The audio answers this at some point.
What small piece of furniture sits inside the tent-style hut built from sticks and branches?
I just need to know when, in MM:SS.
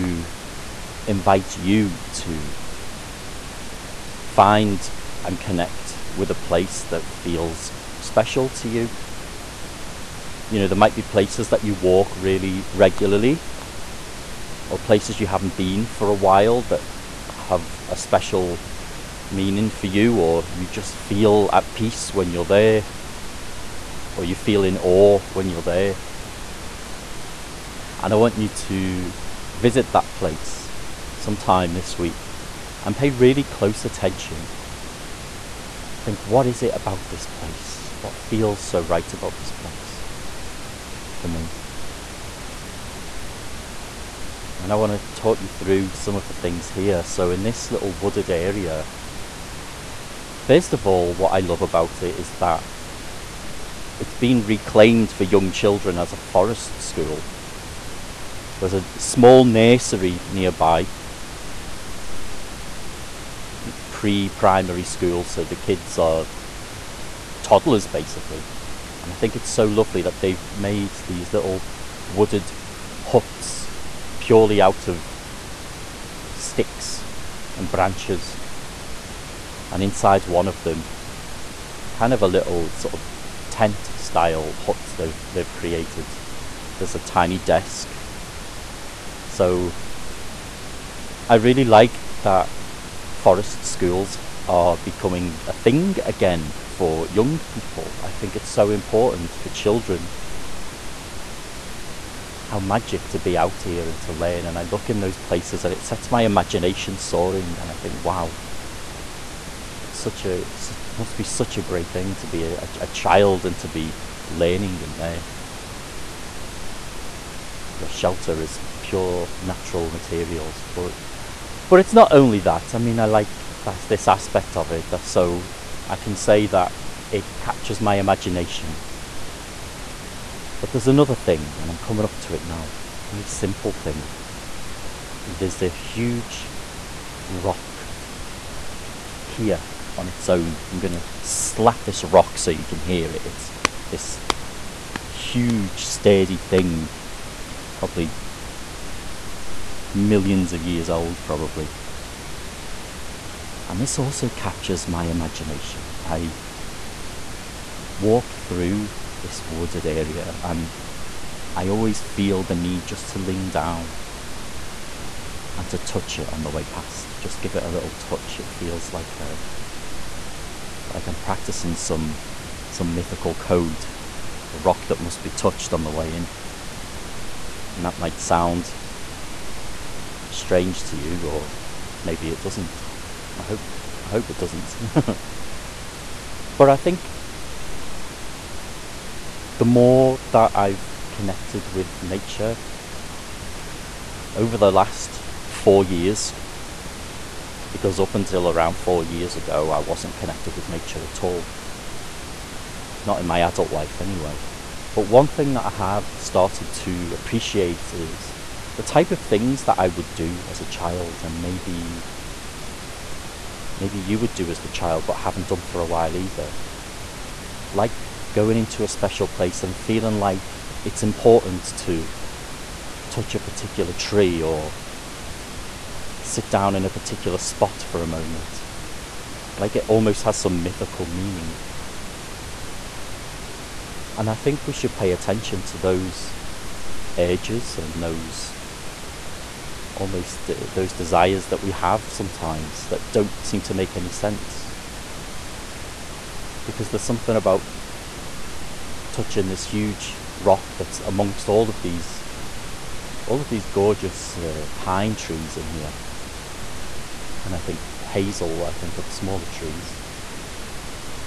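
01:26.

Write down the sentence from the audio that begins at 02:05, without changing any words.
So I can say that it captures my imagination.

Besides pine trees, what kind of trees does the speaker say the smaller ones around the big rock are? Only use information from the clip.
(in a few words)
Hazel.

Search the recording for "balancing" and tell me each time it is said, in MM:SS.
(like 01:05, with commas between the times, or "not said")
not said.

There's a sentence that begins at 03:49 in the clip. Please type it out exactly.
Like it almost has some mythical meaning.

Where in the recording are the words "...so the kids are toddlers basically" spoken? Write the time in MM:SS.
01:05.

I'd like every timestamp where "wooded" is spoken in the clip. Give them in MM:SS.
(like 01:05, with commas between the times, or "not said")
00:47, 01:12, 02:39.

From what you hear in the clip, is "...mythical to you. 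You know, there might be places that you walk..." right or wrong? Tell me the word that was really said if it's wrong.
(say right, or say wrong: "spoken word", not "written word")
wrong: "special", not "mythical".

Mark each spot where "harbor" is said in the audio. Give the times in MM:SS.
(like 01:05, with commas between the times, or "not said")
not said.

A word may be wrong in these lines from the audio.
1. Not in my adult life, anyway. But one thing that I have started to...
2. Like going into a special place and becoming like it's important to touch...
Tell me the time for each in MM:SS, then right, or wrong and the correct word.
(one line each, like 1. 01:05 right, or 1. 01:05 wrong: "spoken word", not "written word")
1. 03:23 right
2. 03:37 wrong: "feeling", not "becoming".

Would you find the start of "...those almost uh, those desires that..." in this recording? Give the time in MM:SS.
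03:58.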